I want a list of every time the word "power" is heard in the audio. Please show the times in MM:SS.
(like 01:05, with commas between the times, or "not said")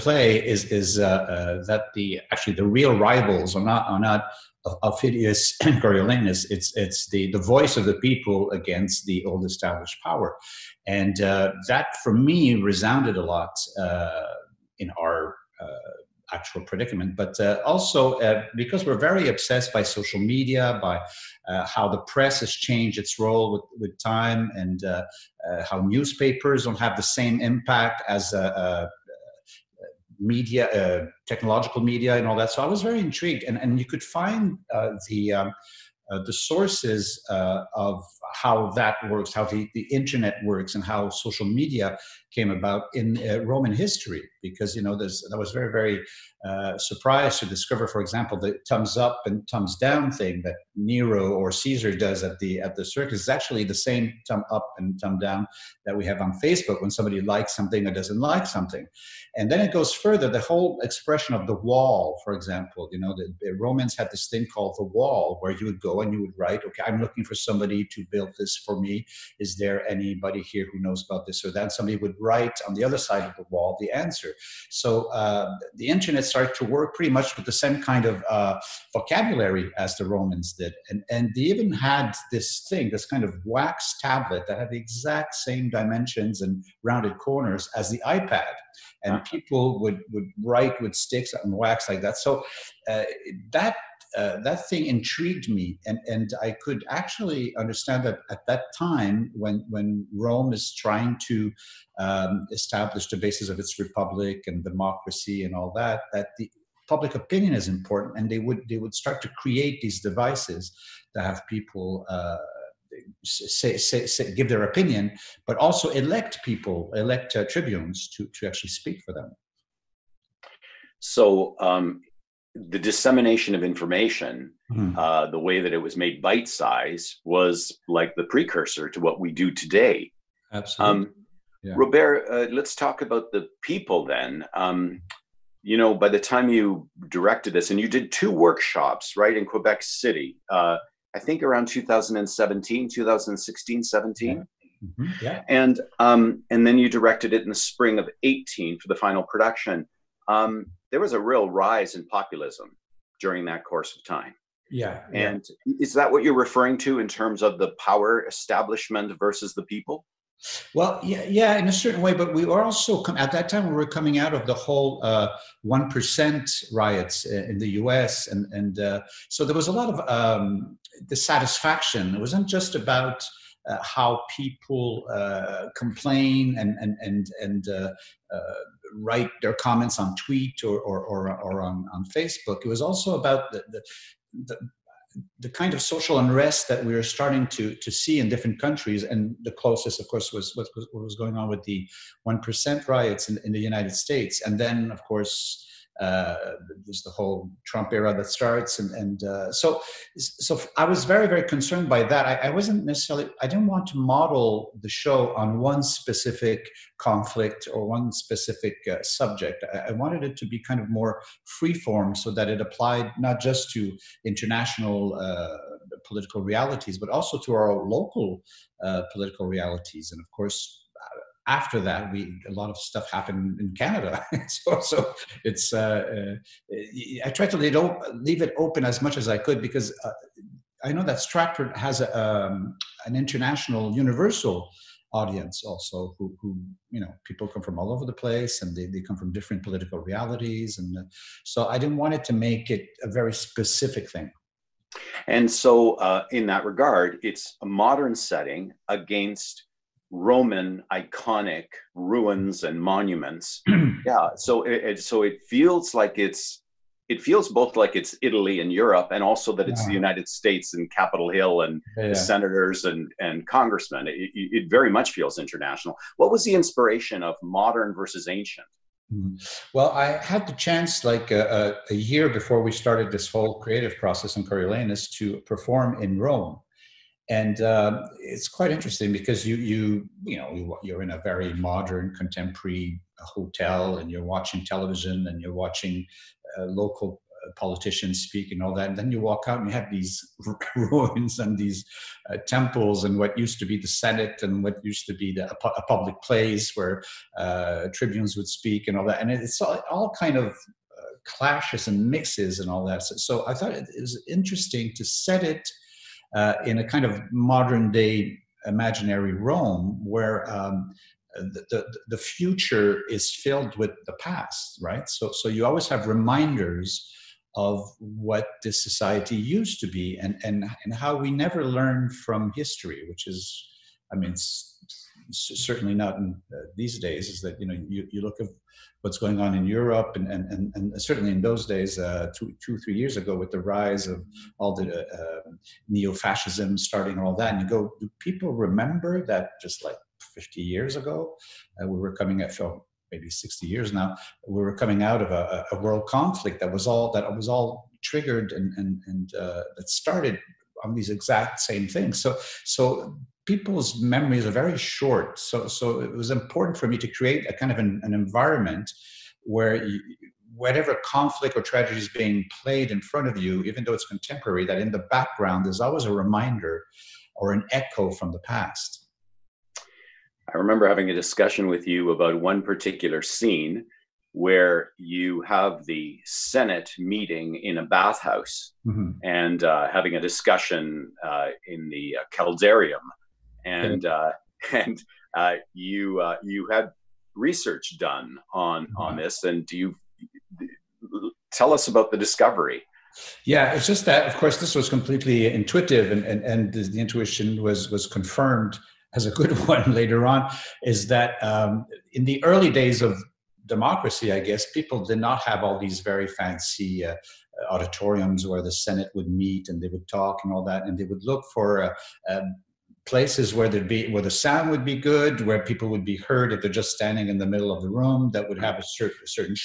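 00:10, 02:37.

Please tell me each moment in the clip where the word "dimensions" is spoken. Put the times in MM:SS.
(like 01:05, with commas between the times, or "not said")
01:25.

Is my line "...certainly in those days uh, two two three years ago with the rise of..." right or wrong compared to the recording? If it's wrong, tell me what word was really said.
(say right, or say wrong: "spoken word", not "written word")
right.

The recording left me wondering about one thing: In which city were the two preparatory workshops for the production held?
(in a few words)
Quebec City.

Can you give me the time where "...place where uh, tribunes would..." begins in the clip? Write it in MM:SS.
04:56.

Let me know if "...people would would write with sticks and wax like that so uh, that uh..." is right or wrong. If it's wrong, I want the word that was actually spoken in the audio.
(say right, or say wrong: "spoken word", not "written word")
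right.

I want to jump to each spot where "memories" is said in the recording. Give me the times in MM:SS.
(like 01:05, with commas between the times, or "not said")
05:54.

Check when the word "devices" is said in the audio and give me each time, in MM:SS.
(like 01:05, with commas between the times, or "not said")
01:50.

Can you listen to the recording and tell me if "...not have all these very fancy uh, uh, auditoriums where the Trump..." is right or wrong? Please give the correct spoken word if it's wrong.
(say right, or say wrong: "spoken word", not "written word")
wrong: "Senate", not "Trump".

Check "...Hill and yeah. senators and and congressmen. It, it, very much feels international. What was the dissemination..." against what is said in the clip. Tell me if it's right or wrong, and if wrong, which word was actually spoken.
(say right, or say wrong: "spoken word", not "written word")
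wrong: "inspiration", not "dissemination".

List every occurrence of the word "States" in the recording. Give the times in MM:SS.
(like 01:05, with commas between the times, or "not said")
03:13, 04:20.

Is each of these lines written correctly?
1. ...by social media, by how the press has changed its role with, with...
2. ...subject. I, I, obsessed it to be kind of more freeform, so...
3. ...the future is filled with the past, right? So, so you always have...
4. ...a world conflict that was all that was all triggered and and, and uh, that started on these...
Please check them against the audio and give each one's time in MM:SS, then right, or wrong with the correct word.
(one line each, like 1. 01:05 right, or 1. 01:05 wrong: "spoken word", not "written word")
1. 00:19 right
2. 03:29 wrong: "wanted", not "obsessed"
3. 05:12 right
4. 05:45 right.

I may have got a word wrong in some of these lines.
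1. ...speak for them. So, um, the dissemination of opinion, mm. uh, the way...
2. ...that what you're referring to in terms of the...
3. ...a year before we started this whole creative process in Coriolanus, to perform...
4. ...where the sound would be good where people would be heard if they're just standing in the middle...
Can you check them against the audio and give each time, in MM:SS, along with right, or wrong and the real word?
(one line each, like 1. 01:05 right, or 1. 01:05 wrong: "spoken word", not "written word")
1. 01:58 wrong: "information", not "opinion"
2. 02:35 right
3. 04:31 right
4. 06:54 right.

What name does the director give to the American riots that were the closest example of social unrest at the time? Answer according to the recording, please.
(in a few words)
one percent riots.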